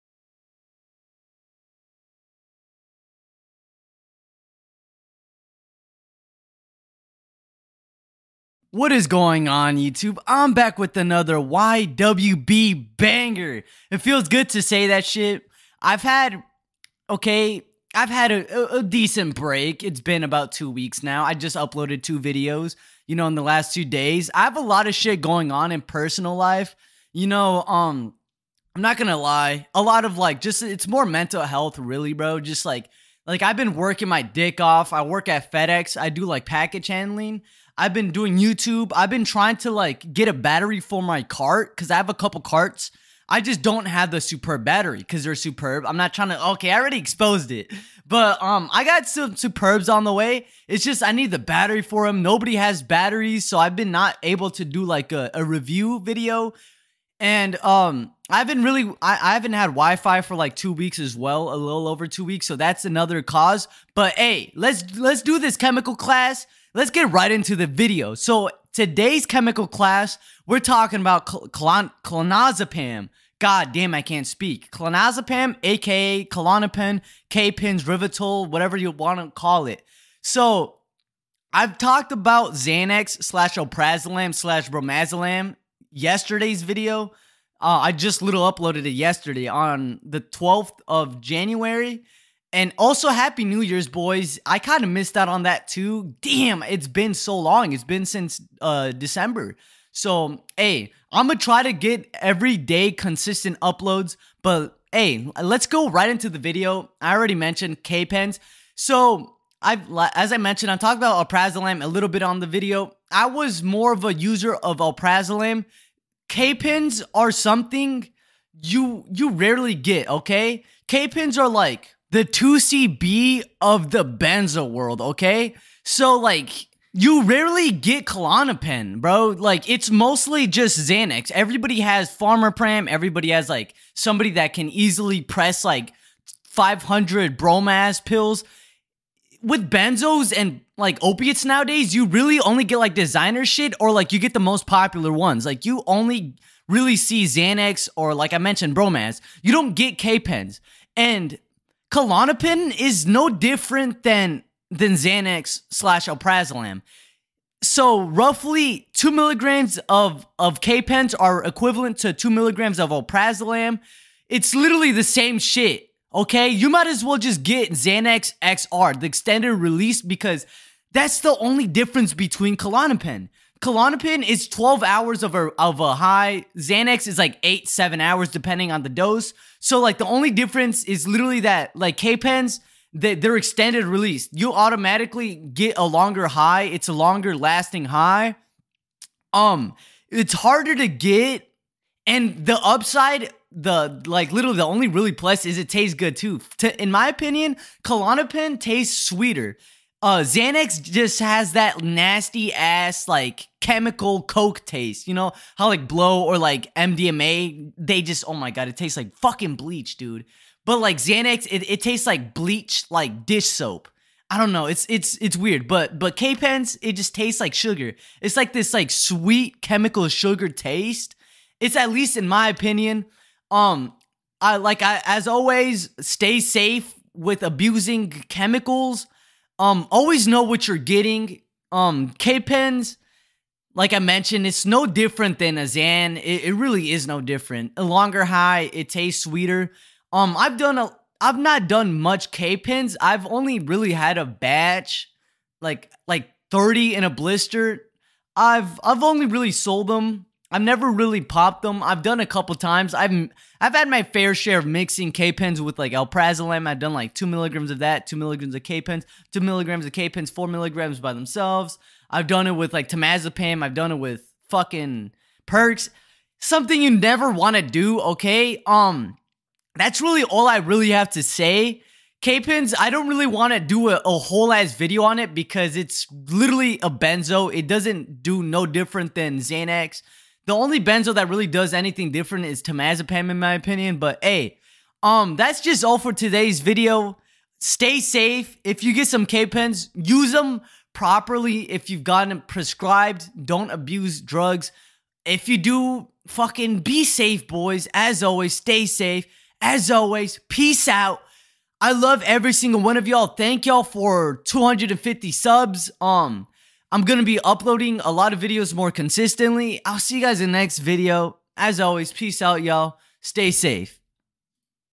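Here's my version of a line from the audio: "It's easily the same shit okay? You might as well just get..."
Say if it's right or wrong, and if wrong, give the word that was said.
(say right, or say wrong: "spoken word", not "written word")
wrong: "literally", not "easily".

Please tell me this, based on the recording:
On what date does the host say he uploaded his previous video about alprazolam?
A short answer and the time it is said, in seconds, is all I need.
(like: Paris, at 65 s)
12th of January, at 90 s.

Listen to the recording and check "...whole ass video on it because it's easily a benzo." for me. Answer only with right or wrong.
wrong.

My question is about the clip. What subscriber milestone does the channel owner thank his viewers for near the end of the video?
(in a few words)
250.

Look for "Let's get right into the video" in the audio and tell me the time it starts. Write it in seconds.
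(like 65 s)
66 s.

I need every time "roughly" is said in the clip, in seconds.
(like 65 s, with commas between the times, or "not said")
158 s.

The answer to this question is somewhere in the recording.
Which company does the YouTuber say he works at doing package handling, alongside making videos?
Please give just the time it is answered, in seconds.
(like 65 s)
35 s.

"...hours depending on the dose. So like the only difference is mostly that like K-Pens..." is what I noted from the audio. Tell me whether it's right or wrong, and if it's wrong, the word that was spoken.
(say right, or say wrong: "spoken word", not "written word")
wrong: "literally", not "mostly".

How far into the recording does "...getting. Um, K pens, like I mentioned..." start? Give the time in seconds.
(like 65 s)
230 s.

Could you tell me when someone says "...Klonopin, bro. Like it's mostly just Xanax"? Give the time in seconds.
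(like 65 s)
128 s.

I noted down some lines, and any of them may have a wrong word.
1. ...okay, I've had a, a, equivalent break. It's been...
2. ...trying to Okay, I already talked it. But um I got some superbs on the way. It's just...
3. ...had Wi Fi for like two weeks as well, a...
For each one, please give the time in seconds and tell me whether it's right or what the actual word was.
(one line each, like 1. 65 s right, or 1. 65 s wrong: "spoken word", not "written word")
1. 17 s wrong: "decent", not "equivalent"
2. 46 s wrong: "exposed", not "talked"
3. 59 s right.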